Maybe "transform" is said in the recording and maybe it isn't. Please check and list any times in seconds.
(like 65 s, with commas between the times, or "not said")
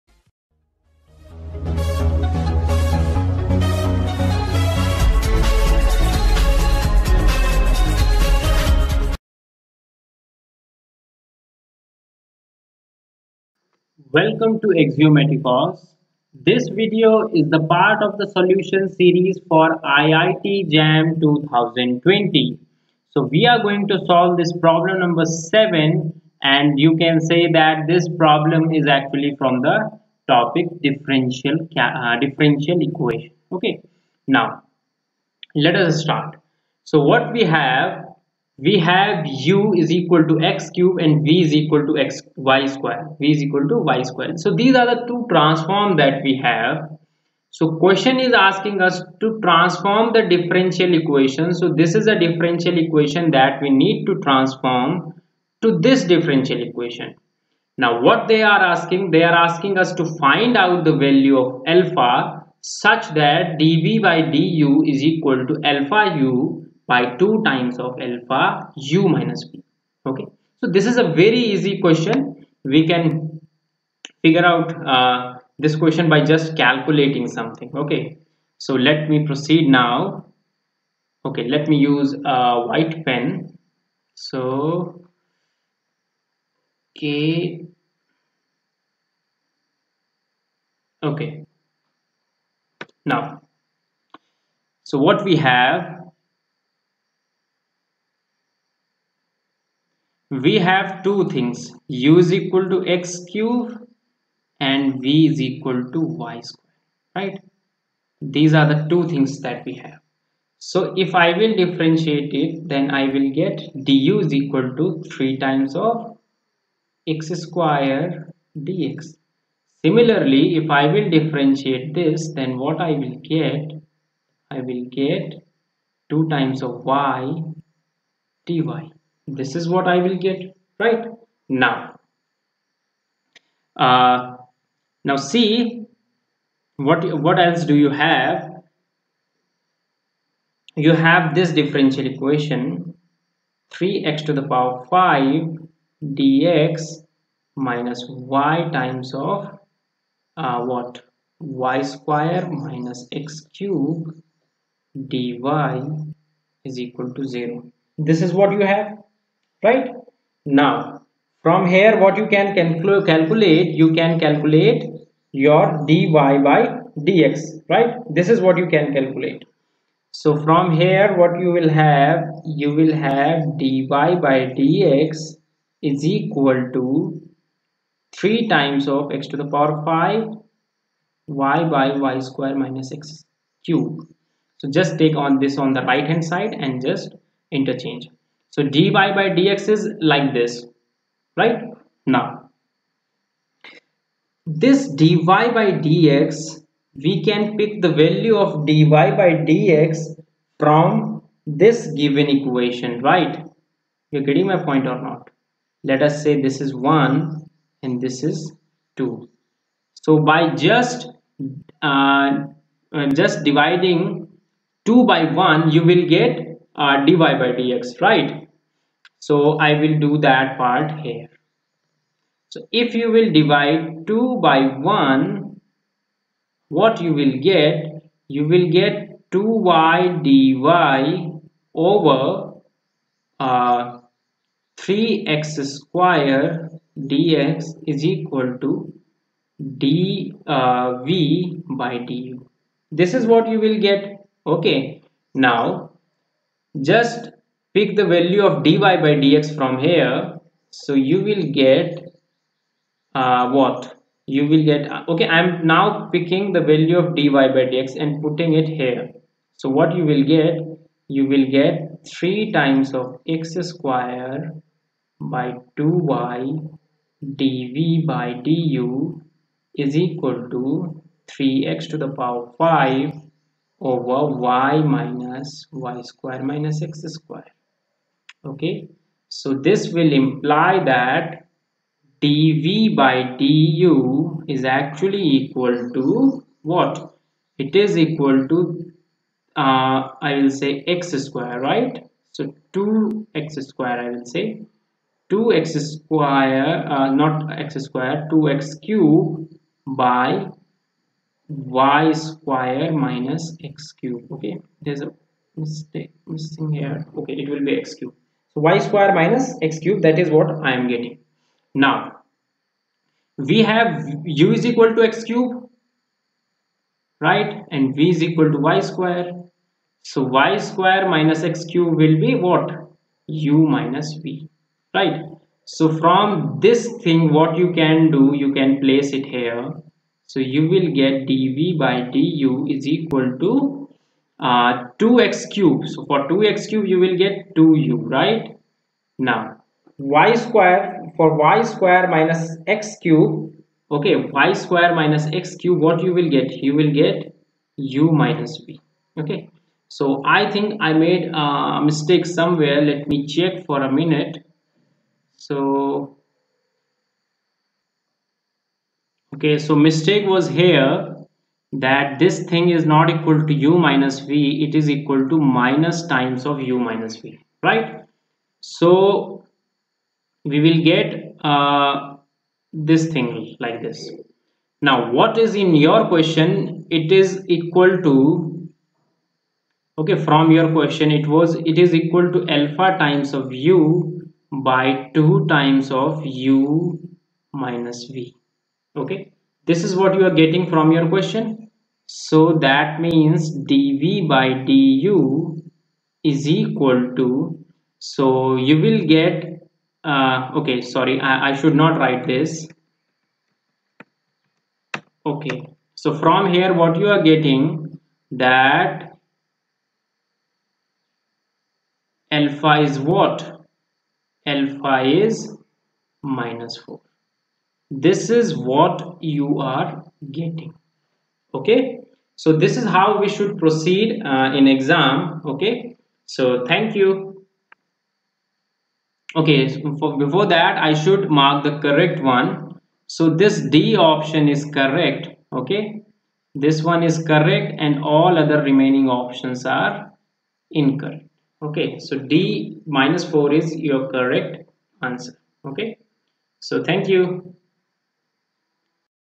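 45 s, 49 s, 54 s.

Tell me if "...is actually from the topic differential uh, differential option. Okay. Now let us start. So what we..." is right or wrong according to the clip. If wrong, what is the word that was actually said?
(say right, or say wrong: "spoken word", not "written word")
wrong: "equation", not "option".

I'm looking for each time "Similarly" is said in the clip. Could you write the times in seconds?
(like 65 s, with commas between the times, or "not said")
119 s.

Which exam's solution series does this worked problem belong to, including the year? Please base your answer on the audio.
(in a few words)
IIT JAM 2020.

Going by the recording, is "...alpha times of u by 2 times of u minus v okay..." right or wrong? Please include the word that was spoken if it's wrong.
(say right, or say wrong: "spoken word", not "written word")
right.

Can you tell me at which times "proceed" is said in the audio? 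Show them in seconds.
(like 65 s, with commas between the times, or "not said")
79 s, 423 s.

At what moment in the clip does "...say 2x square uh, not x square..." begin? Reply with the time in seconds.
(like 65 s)
294 s.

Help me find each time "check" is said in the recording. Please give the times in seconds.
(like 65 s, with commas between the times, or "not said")
353 s.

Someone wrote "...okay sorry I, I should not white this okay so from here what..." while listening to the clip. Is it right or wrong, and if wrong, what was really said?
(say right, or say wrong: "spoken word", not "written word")
wrong: "write", not "white".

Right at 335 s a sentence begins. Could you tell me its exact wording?
So for 2x cube, you will get 2u, right?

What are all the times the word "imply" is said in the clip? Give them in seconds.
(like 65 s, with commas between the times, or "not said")
280 s.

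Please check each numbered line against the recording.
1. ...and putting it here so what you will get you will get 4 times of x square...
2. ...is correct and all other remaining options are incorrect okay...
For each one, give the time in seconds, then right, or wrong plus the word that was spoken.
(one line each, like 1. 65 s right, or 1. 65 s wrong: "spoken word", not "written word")
1. 257 s wrong: "3", not "4"
2. 437 s right.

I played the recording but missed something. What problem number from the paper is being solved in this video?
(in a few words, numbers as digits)
7.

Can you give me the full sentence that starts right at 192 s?
Now, this dy by dx, we can pick the value of dy by dx from this given equation, right?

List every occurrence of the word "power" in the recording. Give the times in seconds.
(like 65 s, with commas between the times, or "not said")
144 s, 179 s, 272 s.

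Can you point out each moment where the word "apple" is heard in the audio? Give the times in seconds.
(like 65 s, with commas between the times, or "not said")
not said.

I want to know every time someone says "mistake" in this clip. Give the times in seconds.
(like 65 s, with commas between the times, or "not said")
305 s, 351 s, 359 s.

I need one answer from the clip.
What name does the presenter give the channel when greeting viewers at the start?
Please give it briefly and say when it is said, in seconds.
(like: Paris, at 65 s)
Axiomatikos, at 14 s.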